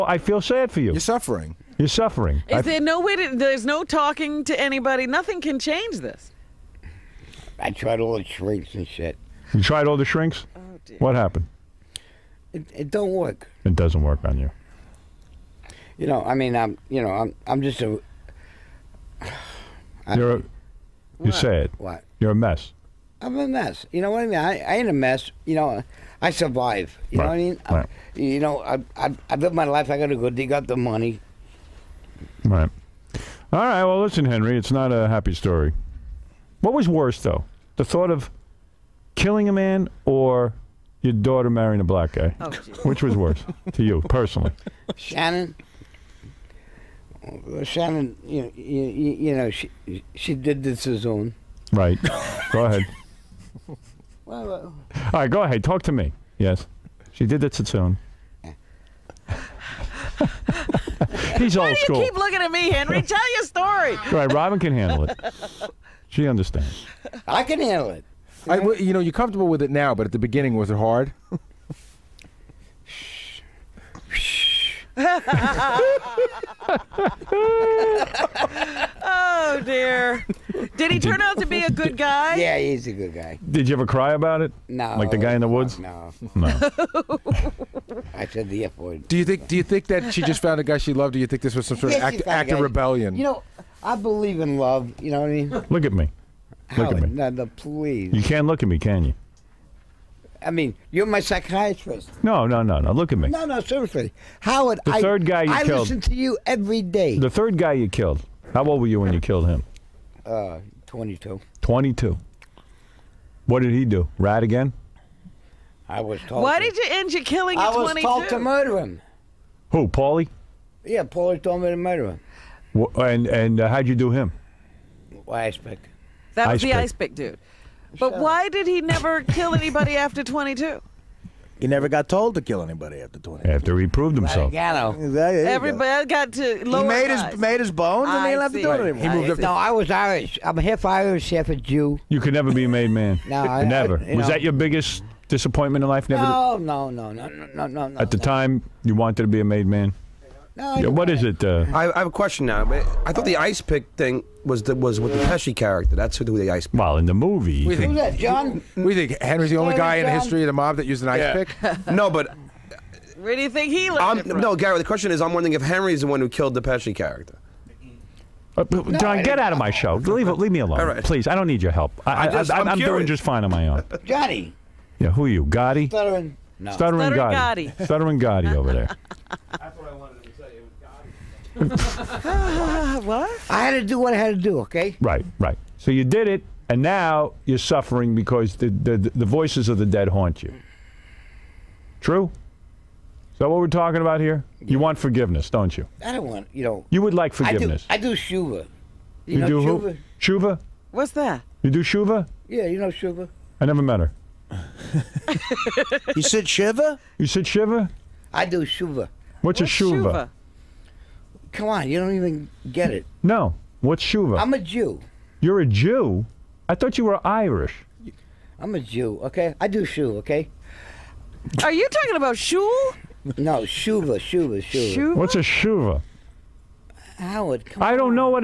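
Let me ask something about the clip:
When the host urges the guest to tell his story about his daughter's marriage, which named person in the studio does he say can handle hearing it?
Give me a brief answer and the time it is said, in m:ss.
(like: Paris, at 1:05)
Robin, at 1:04.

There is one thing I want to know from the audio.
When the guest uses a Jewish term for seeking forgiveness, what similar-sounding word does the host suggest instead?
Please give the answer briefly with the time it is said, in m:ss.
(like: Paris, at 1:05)
Shul, at 3:42.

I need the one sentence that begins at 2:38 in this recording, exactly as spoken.
We think Henry's the only guy John?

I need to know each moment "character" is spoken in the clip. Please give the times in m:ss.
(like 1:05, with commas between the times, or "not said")
2:35, 2:46.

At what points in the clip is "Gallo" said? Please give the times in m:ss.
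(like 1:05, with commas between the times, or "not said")
2:14.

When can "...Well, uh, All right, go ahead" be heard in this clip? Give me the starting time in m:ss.
0:54.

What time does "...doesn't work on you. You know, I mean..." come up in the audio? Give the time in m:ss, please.
0:13.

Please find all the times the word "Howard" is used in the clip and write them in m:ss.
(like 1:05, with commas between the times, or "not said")
1:44, 3:47.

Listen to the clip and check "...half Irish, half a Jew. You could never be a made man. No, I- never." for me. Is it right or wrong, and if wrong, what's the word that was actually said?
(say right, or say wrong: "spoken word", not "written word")
right.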